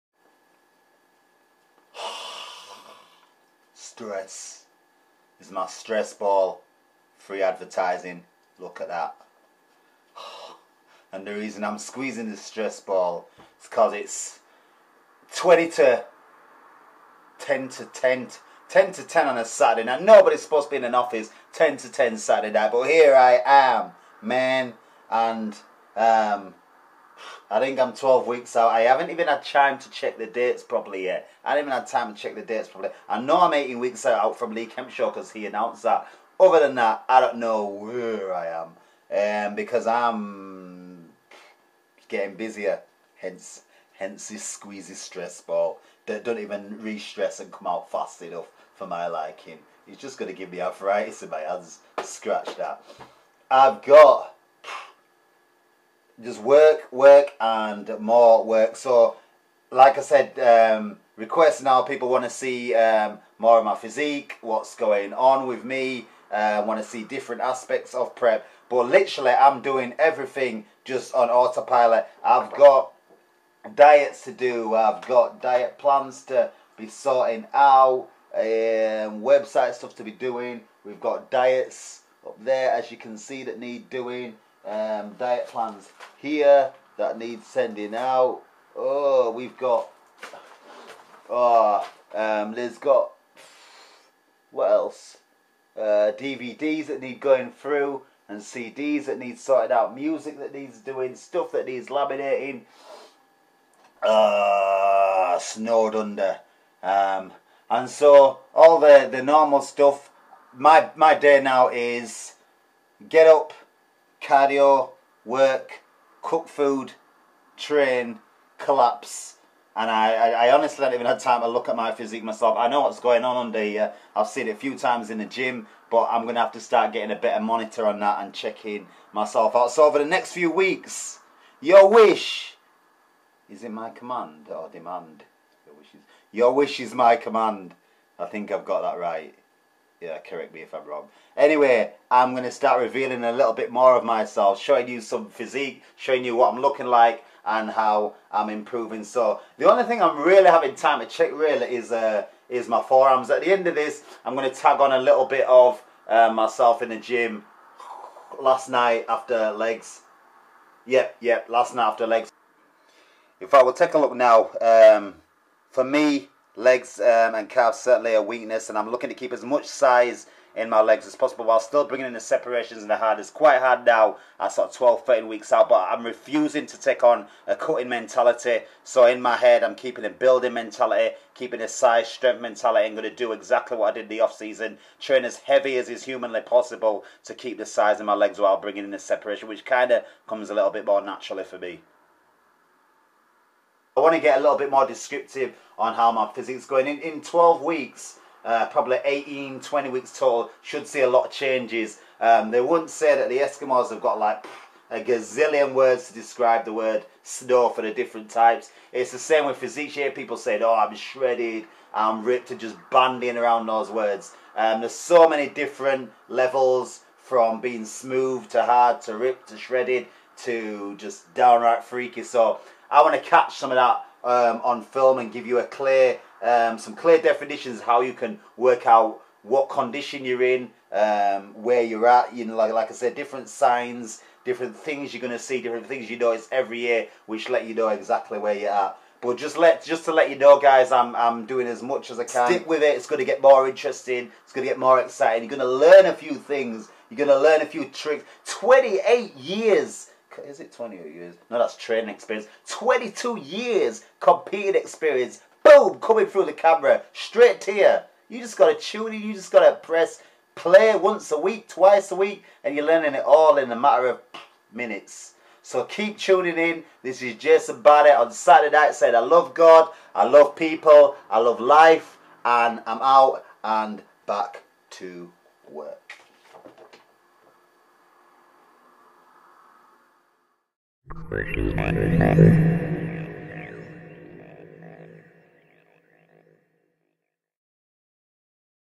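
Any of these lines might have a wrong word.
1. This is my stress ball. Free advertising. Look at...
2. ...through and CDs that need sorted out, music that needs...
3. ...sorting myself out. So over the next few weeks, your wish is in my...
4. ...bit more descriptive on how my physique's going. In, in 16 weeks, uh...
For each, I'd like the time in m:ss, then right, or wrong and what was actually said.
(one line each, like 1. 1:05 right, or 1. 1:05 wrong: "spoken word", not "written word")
1. 0:05 right
2. 1:37 right
3. 2:08 wrong: "checking", not "sorting"
4. 3:14 wrong: "12", not "16".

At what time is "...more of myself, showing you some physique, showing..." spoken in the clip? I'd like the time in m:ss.
2:23.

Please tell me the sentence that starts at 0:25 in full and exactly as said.
And um, I think I'm 12 weeks out.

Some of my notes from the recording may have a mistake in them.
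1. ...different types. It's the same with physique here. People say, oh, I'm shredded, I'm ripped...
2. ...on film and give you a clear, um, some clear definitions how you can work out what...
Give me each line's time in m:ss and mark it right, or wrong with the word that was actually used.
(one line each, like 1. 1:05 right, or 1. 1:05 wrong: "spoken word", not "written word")
1. 3:27 right
2. 3:44 right.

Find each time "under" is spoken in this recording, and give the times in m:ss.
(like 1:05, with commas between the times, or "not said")
1:45, 2:03.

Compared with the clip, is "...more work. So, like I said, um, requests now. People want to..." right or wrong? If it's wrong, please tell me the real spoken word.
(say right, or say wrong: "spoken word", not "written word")
right.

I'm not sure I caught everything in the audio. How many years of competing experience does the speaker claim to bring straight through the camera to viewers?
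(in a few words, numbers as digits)
22.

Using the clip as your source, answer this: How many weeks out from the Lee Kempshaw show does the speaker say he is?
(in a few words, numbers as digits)
18.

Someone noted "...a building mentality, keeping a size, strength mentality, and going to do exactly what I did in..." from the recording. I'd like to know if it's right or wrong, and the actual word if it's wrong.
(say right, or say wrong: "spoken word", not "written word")
right.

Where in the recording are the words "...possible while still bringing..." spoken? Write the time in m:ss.
2:51.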